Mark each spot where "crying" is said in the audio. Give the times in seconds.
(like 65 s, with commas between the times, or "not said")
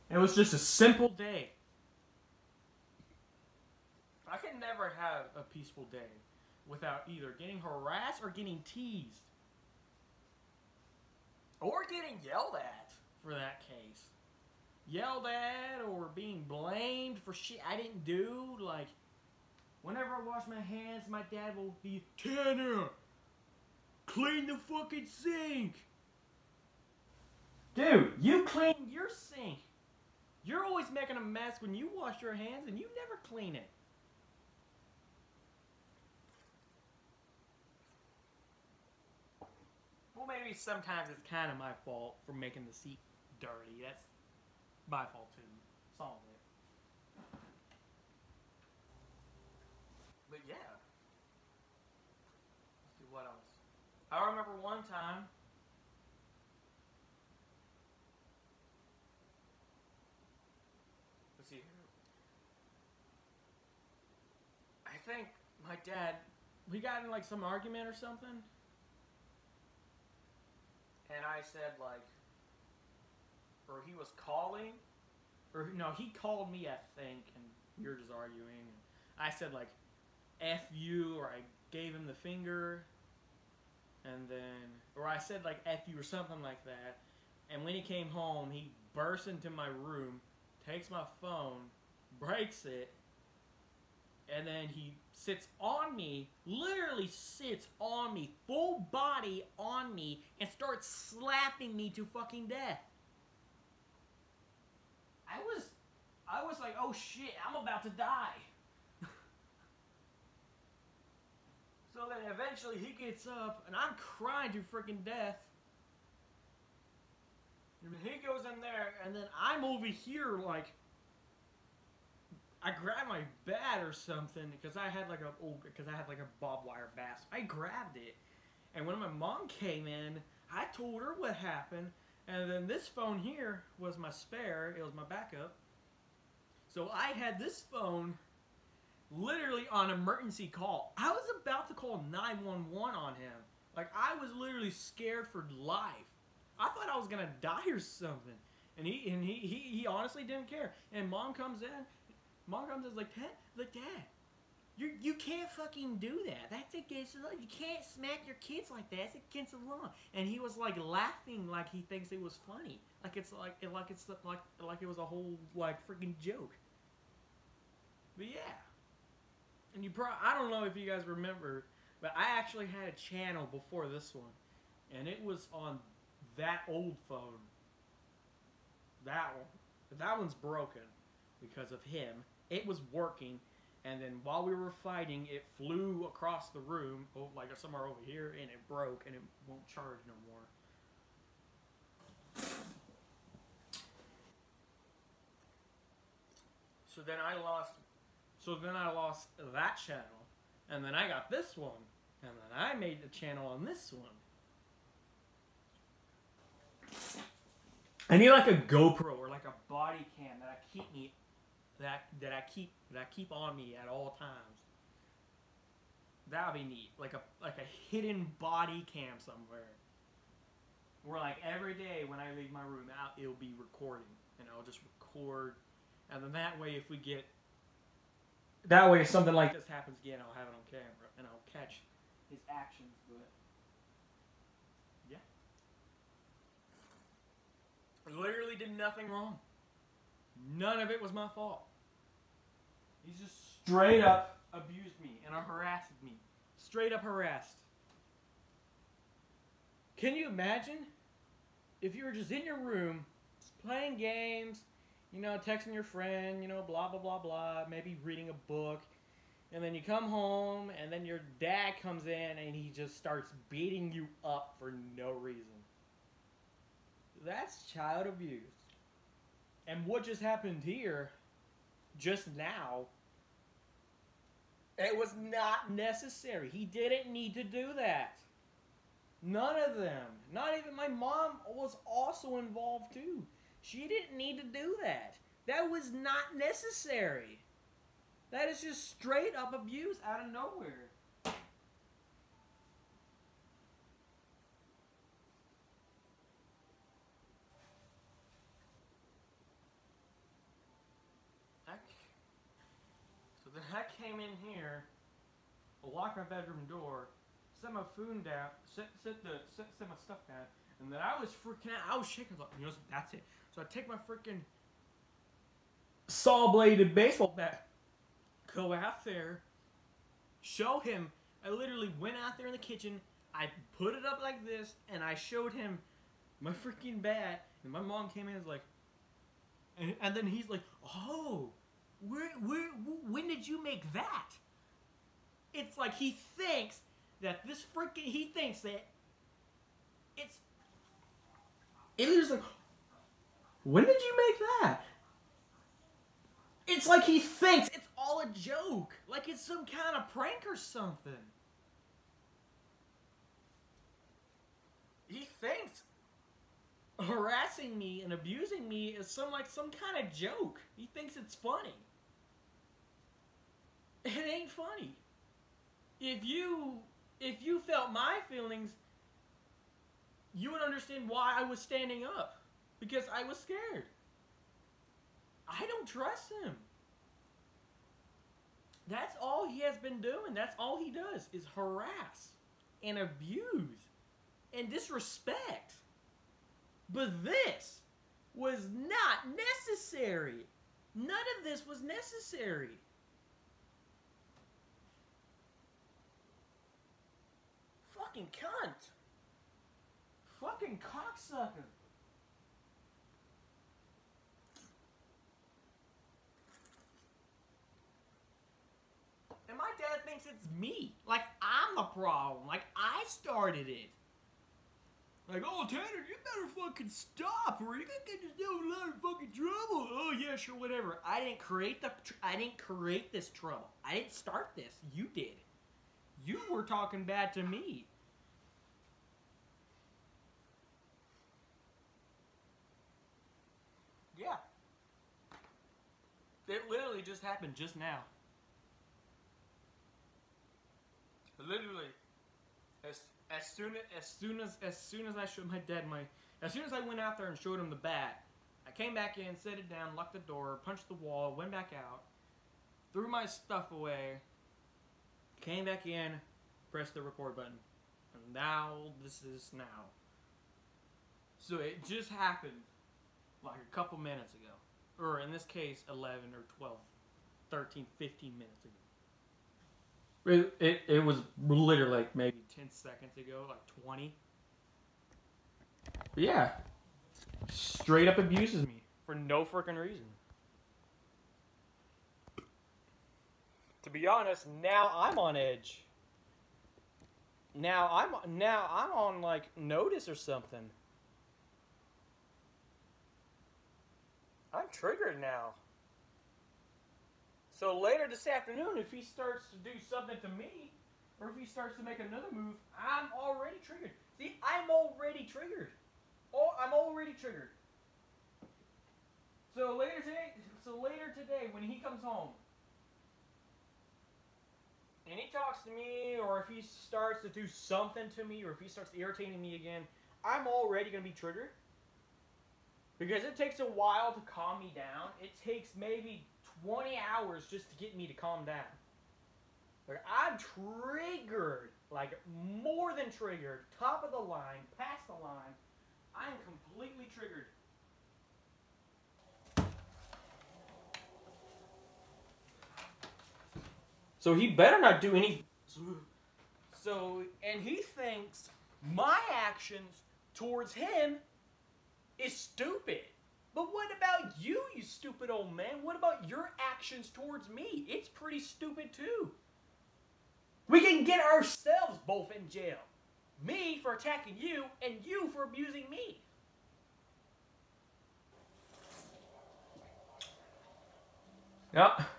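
113 s.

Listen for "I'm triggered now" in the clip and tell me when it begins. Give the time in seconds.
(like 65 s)
494 s.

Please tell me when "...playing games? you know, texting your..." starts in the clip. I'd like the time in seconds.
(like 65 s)
253 s.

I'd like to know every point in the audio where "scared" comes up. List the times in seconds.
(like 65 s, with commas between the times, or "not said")
144 s, 373 s.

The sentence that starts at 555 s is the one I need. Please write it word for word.
What about your actions towards me?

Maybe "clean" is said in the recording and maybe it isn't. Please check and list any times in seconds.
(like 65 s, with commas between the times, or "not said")
24 s, 28 s, 33 s.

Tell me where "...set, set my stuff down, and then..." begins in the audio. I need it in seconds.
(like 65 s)
309 s.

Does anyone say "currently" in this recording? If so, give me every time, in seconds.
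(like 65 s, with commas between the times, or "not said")
not said.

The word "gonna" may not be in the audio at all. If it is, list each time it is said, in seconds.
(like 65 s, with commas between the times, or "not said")
147 s, 417 s, 520 s.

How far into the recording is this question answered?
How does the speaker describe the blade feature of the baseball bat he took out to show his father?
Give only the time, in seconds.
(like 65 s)
316 s.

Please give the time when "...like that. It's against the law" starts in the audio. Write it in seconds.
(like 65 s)
158 s.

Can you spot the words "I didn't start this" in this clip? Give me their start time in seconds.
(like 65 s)
423 s.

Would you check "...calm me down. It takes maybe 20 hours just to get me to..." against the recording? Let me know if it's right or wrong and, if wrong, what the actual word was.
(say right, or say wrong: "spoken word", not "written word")
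right.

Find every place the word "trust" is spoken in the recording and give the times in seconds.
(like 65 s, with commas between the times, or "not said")
375 s.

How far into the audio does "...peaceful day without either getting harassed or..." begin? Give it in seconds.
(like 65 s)
5 s.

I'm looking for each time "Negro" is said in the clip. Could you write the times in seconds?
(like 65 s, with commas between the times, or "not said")
not said.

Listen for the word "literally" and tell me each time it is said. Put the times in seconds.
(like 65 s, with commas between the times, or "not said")
96 s, 139 s, 144 s, 238 s, 321 s, 436 s, 441 s, 471 s.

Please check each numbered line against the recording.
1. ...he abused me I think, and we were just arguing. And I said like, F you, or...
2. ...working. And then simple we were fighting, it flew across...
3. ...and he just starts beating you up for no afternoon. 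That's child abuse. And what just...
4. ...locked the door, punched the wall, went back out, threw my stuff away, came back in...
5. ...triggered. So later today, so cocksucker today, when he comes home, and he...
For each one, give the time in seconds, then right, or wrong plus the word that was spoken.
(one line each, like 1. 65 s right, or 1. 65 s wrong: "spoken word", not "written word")
1. 75 s wrong: "called", not "abused"
2. 182 s wrong: "while", not "simple"
3. 262 s wrong: "reason", not "afternoon"
4. 449 s right
5. 507 s wrong: "later", not "cocksucker".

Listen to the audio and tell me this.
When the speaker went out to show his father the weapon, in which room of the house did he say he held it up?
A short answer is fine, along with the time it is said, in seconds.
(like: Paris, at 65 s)
kitchen, at 322 s.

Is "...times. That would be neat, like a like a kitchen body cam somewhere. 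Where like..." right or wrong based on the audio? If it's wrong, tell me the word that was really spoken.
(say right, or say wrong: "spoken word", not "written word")
wrong: "hidden", not "kitchen".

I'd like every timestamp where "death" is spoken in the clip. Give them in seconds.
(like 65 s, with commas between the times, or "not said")
102 s, 115 s.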